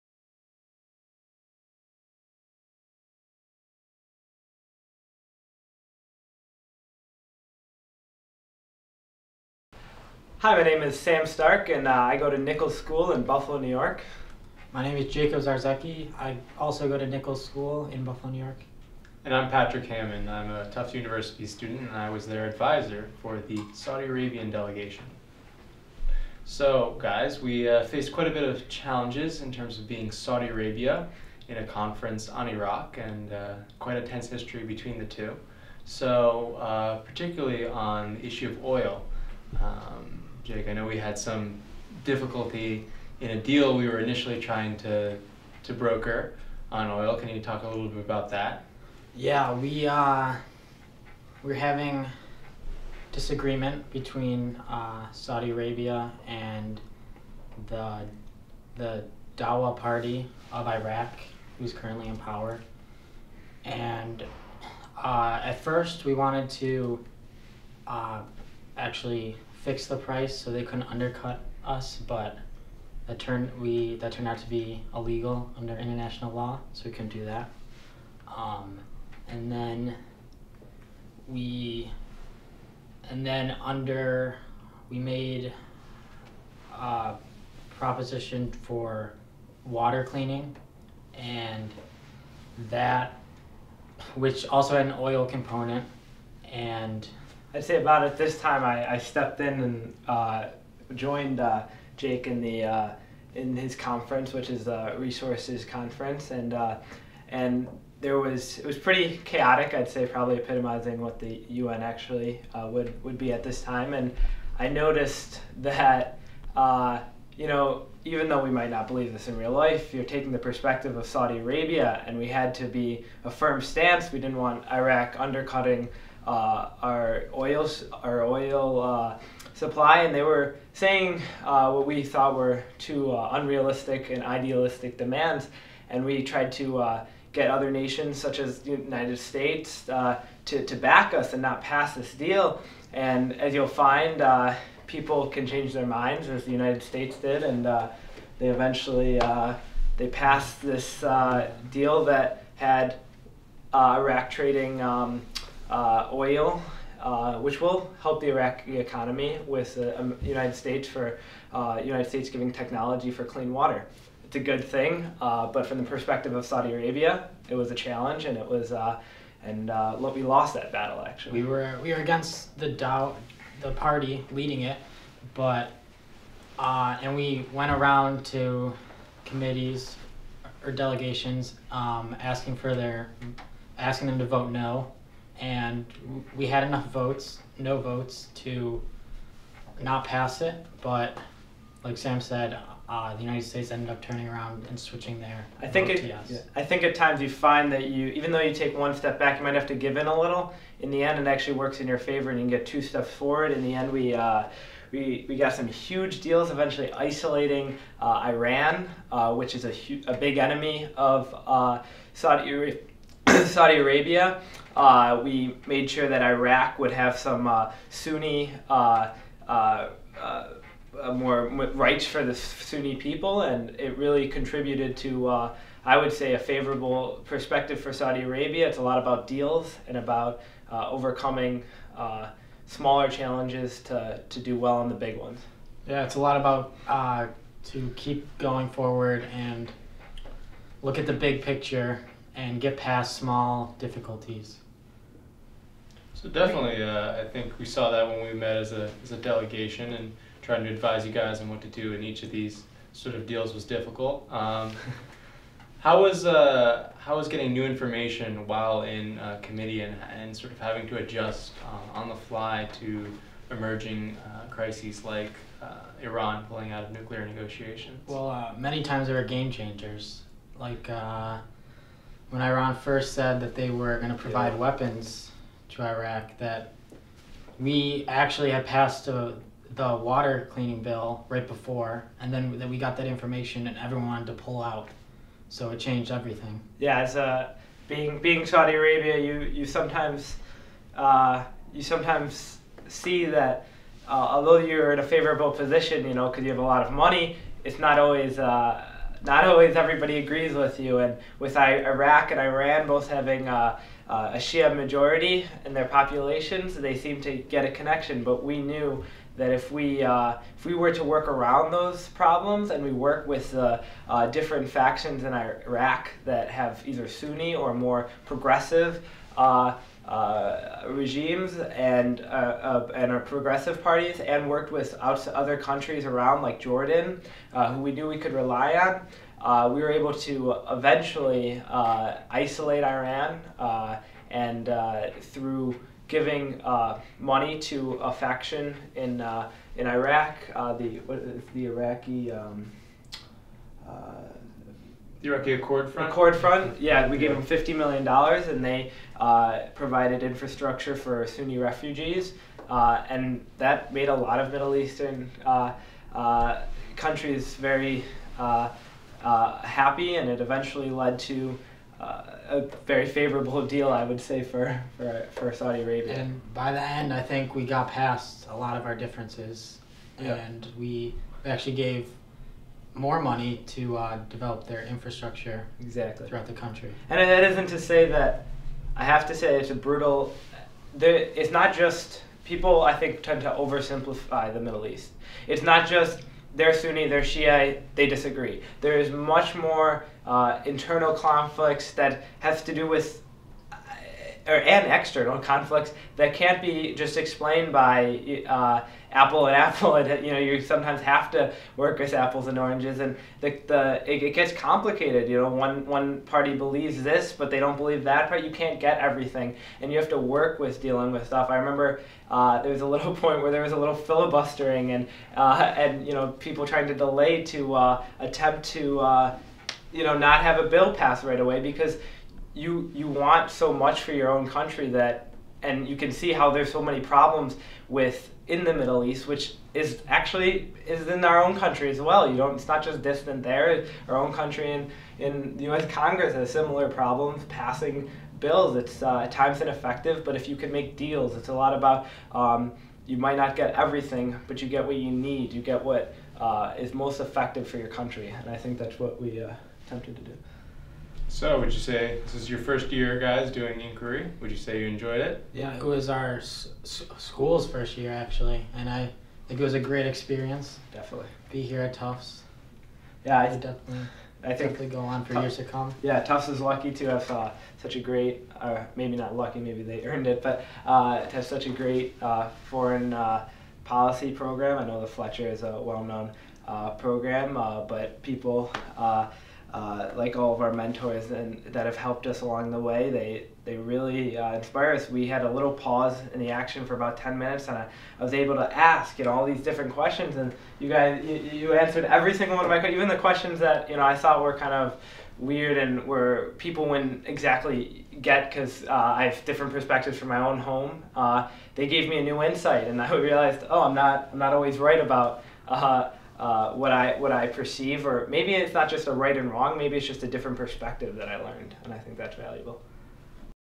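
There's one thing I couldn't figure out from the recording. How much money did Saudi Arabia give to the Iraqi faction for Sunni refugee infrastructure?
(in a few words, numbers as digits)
$50 million.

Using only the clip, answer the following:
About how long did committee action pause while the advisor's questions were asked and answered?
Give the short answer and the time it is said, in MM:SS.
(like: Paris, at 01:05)
10 minutes, at 08:07.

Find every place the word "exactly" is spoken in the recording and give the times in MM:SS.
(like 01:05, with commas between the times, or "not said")
06:15, 08:17.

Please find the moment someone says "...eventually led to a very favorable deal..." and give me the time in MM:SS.
06:00.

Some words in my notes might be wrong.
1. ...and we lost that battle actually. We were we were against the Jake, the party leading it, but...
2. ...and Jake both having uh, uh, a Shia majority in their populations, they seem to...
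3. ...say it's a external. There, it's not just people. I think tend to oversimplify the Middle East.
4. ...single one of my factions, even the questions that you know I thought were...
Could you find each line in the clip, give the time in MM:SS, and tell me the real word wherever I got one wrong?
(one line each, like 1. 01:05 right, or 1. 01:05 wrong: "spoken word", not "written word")
1. 02:49 wrong: "Dow", not "Jake"
2. 05:02 wrong: "Iran", not "Jake"
3. 06:19 wrong: "brutal", not "external"
4. 08:12 wrong: "questions", not "factions".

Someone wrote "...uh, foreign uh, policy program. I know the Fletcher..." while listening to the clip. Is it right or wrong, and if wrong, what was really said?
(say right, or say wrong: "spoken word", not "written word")
right.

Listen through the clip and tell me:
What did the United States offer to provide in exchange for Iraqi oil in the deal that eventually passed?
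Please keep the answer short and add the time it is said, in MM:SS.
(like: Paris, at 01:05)
technology for clean water, at 02:42.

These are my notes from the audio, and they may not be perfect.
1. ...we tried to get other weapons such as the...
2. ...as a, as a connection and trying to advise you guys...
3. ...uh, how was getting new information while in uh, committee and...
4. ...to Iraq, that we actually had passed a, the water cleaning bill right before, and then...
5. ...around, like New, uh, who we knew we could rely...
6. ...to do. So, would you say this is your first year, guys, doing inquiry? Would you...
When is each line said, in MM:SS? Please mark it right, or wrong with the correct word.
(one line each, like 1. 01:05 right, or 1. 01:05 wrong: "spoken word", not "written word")
1. 02:16 wrong: "nations", not "weapons"
2. 04:08 wrong: "delegation", not "connection"
3. 04:16 right
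4. 04:35 right
5. 05:26 wrong: "Jordan", not "New"
6. 07:30 right.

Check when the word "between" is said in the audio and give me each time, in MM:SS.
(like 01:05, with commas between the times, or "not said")
00:34, 00:53.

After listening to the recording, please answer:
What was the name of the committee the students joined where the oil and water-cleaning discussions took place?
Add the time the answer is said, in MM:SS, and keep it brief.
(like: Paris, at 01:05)
resources conference, at 01:44.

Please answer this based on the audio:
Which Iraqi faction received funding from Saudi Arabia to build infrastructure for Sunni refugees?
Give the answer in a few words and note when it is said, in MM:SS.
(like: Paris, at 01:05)
Iraqi Accord Front, at 05:45.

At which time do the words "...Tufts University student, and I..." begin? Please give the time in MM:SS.
00:20.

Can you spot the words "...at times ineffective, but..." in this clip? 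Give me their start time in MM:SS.
07:19.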